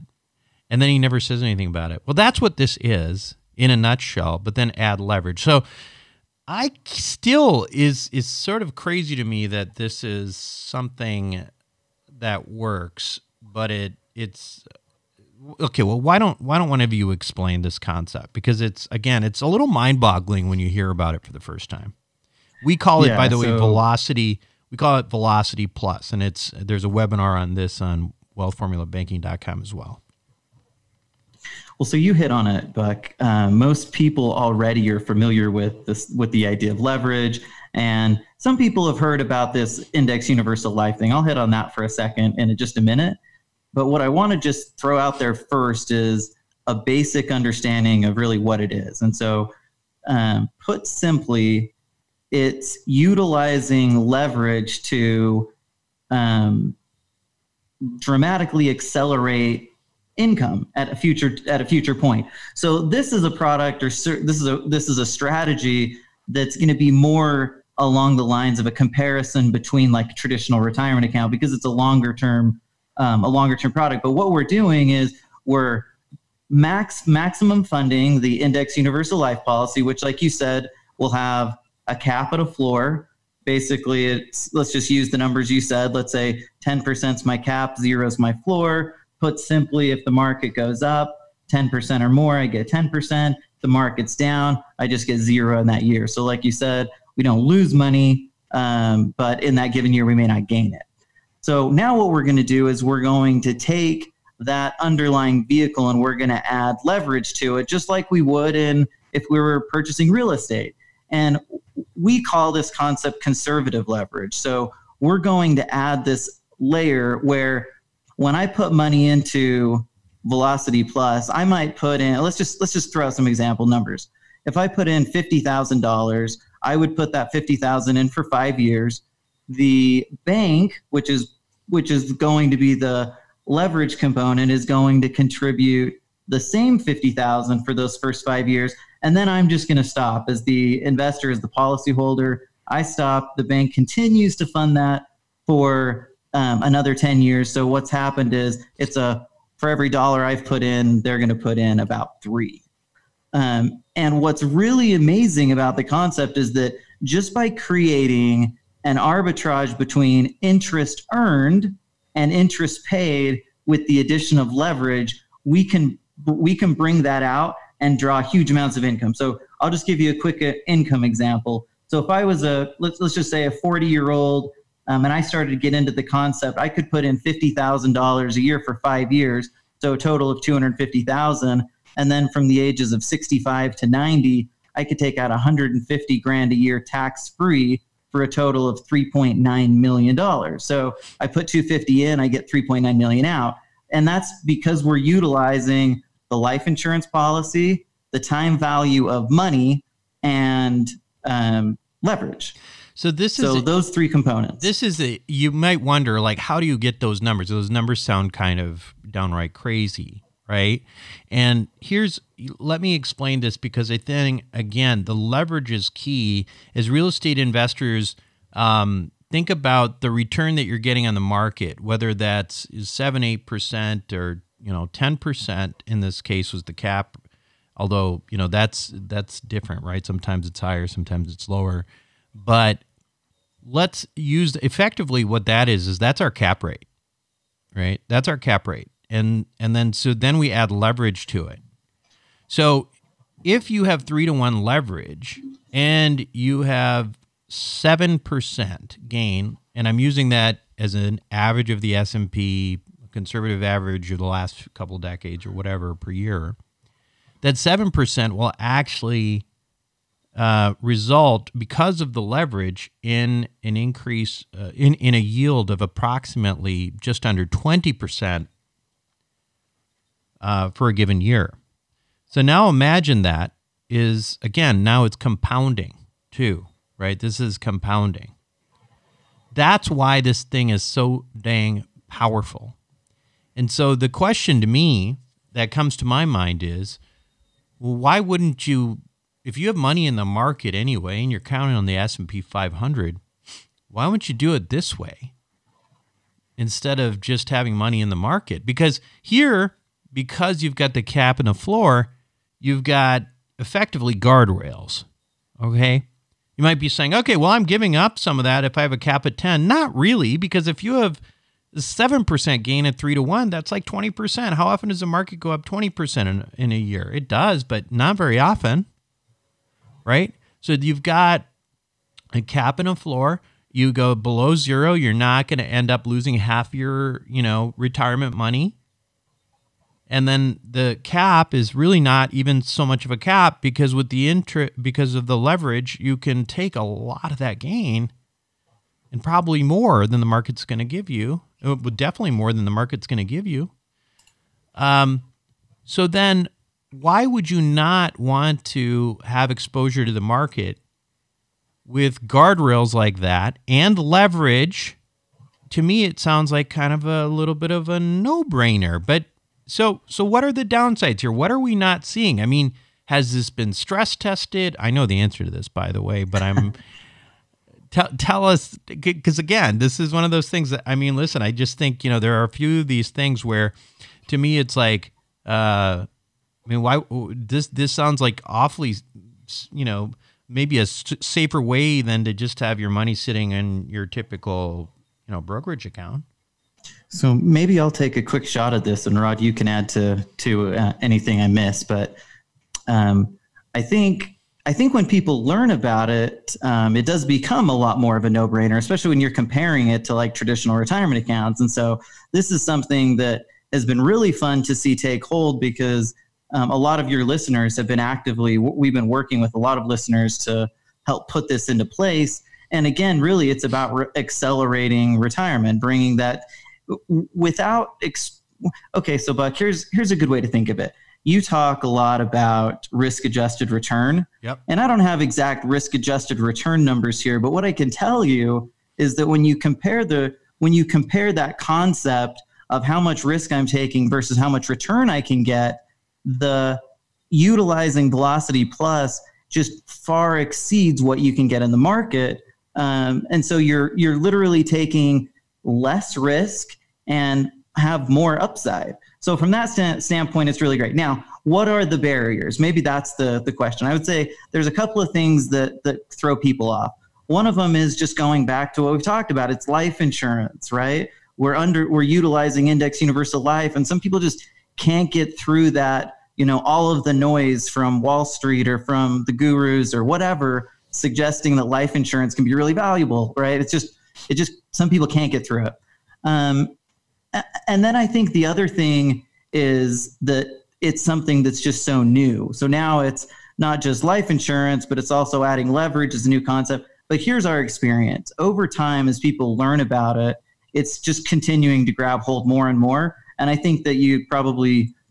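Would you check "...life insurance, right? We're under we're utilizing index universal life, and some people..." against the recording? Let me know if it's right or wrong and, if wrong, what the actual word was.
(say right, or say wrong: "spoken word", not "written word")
right.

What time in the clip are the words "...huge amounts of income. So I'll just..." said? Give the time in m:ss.
2:48.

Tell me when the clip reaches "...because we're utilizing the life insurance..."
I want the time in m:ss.
3:14.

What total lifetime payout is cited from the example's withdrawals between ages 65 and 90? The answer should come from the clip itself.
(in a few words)
$3.9 million.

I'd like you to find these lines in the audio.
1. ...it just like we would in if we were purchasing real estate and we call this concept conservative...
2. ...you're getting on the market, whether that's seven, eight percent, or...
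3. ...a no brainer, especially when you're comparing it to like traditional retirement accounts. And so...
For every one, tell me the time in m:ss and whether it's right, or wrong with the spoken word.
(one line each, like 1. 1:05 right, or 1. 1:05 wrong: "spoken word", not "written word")
1. 1:47 right
2. 3:40 right
3. 6:38 right.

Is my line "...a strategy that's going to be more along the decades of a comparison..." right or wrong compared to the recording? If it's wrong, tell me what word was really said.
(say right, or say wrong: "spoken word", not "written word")
wrong: "lines", not "decades".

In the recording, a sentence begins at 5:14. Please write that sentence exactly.
How often does the market go up 20% in, in a year?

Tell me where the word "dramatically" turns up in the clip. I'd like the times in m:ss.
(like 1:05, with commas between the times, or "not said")
0:57.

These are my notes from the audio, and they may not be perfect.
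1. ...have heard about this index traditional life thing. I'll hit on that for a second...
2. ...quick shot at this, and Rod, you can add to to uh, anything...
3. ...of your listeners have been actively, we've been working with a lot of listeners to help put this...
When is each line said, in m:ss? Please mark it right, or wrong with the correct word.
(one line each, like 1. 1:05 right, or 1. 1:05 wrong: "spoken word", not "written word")
1. 0:38 wrong: "universal", not "traditional"
2. 6:28 right
3. 6:46 right.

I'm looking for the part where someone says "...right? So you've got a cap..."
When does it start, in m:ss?
5:20.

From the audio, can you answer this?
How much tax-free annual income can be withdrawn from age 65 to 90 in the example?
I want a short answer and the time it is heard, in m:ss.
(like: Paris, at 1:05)
$150,000, at 3:05.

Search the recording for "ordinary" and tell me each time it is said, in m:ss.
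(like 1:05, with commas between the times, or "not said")
not said.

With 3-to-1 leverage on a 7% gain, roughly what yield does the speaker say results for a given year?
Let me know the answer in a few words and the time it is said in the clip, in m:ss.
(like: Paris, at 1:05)
just under 20%, at 4:27.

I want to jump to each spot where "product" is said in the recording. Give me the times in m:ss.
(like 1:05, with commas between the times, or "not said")
1:03, 1:13.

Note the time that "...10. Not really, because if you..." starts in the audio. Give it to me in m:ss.
5:09.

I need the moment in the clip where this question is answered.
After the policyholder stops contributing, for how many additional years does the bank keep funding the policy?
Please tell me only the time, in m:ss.
2:26.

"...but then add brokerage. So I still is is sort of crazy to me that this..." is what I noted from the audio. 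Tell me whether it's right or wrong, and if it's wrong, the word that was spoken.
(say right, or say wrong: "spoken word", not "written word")
wrong: "leverage", not "brokerage".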